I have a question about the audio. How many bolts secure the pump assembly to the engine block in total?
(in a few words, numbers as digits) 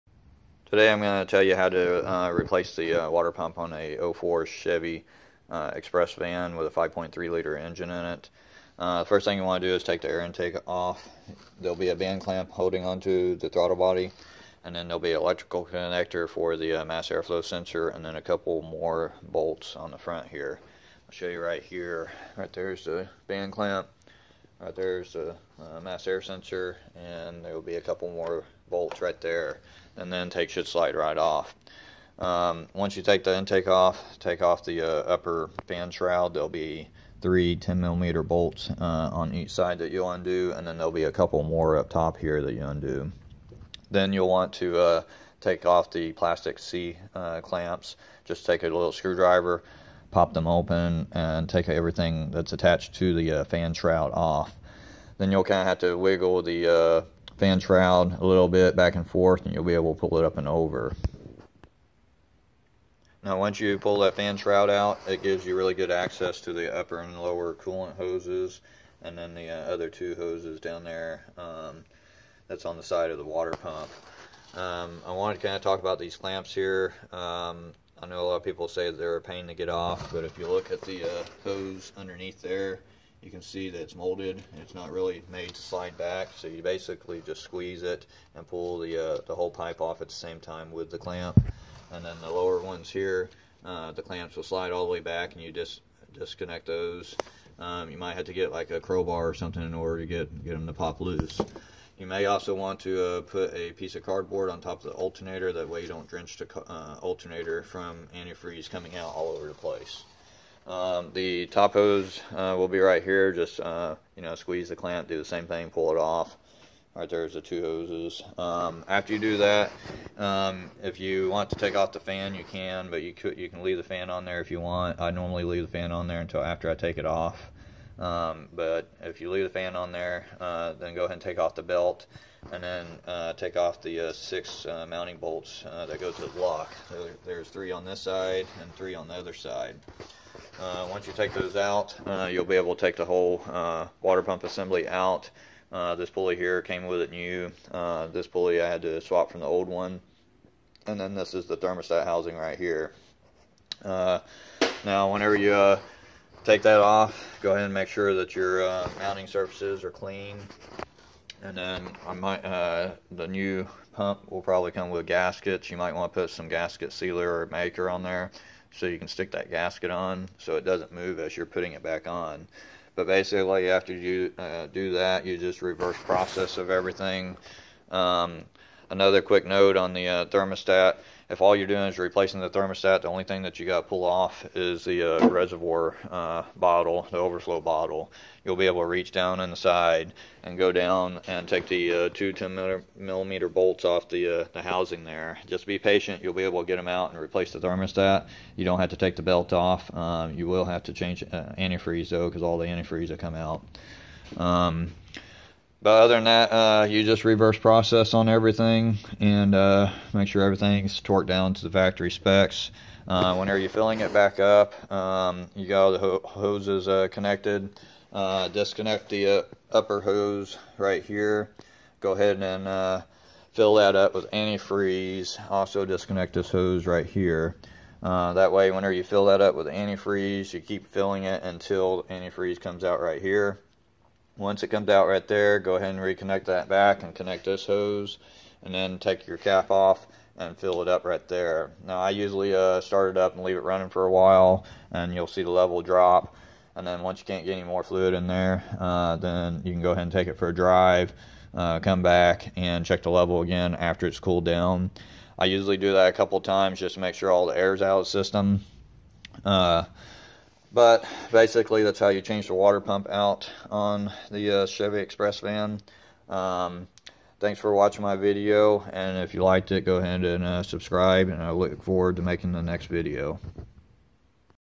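6.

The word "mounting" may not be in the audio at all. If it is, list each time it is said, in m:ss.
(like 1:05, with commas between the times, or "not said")
2:14, 2:38.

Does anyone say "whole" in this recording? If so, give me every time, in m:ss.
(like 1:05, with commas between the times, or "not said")
1:29, 2:23.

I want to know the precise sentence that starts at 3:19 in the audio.
Um, you will have to change uh, antifreeze, though, because all the antifreeze will come out.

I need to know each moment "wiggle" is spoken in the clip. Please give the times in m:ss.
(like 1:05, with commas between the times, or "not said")
0:55.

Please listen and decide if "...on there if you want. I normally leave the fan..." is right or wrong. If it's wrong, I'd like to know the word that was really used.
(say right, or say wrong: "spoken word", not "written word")
right.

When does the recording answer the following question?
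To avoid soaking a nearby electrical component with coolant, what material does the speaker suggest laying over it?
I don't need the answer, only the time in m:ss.
1:44.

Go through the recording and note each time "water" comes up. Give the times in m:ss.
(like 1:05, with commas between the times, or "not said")
0:03, 1:13, 2:24, 4:22.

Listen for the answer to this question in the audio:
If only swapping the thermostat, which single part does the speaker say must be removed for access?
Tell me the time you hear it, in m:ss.
3:07.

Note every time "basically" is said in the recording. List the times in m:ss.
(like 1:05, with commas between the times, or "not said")
1:26, 2:53, 4:21.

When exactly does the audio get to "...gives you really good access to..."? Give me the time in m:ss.
1:05.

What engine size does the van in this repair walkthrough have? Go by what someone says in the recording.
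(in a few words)
5.3 liter.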